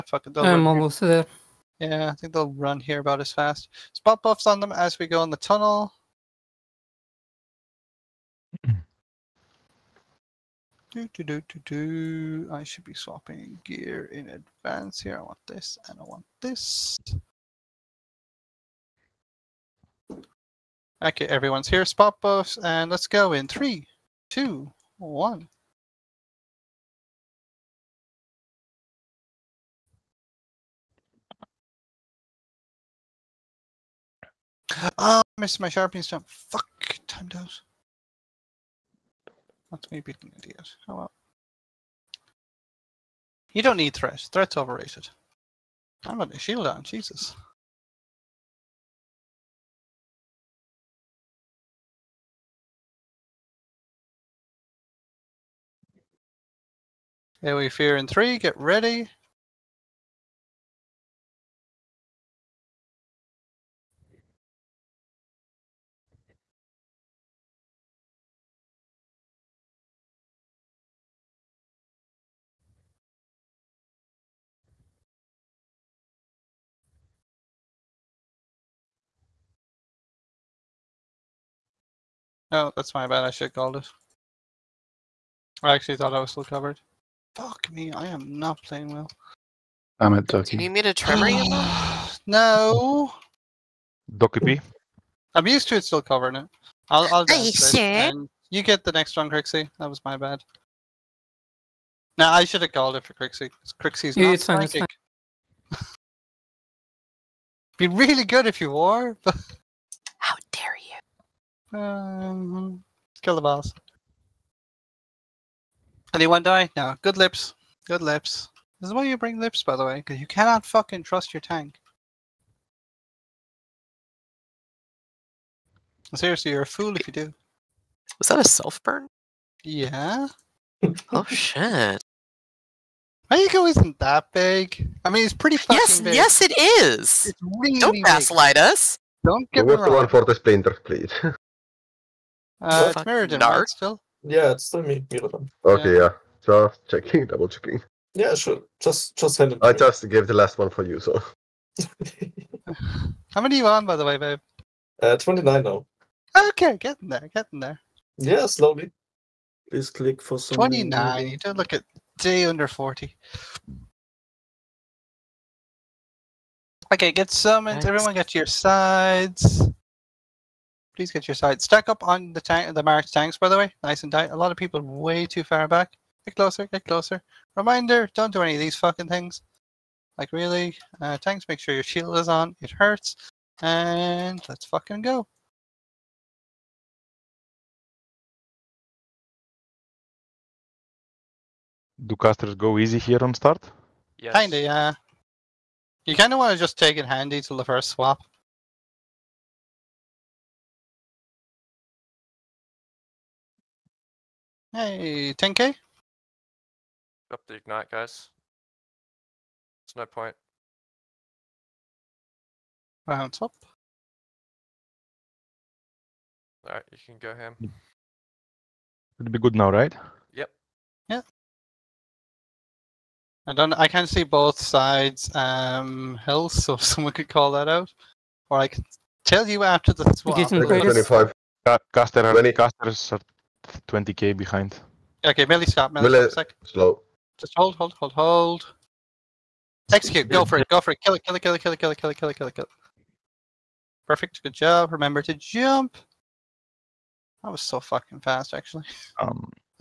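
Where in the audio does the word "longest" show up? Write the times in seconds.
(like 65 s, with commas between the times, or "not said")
not said.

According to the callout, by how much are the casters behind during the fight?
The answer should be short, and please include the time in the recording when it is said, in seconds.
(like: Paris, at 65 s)
20k, at 233 s.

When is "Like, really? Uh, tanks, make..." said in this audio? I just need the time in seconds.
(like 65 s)
180 s.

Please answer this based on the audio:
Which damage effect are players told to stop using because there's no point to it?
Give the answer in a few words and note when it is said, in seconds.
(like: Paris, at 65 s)
ignite, at 207 s.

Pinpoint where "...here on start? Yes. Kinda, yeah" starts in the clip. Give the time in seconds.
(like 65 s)
192 s.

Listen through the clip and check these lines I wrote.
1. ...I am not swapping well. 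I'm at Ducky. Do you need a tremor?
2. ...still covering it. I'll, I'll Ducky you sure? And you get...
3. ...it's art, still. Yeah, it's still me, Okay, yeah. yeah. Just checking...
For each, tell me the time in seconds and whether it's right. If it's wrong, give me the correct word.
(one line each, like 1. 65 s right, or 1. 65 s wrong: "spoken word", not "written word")
1. 87 s wrong: "playing", not "swapping"
2. 95 s wrong: "Are", not "Ducky"
3. 142 s right.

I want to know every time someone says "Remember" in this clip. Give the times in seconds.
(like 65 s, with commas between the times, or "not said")
244 s.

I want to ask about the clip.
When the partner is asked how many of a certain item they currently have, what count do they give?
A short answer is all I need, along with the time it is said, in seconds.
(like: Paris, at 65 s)
29, at 155 s.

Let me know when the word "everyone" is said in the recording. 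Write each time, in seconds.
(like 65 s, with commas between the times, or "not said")
21 s, 167 s.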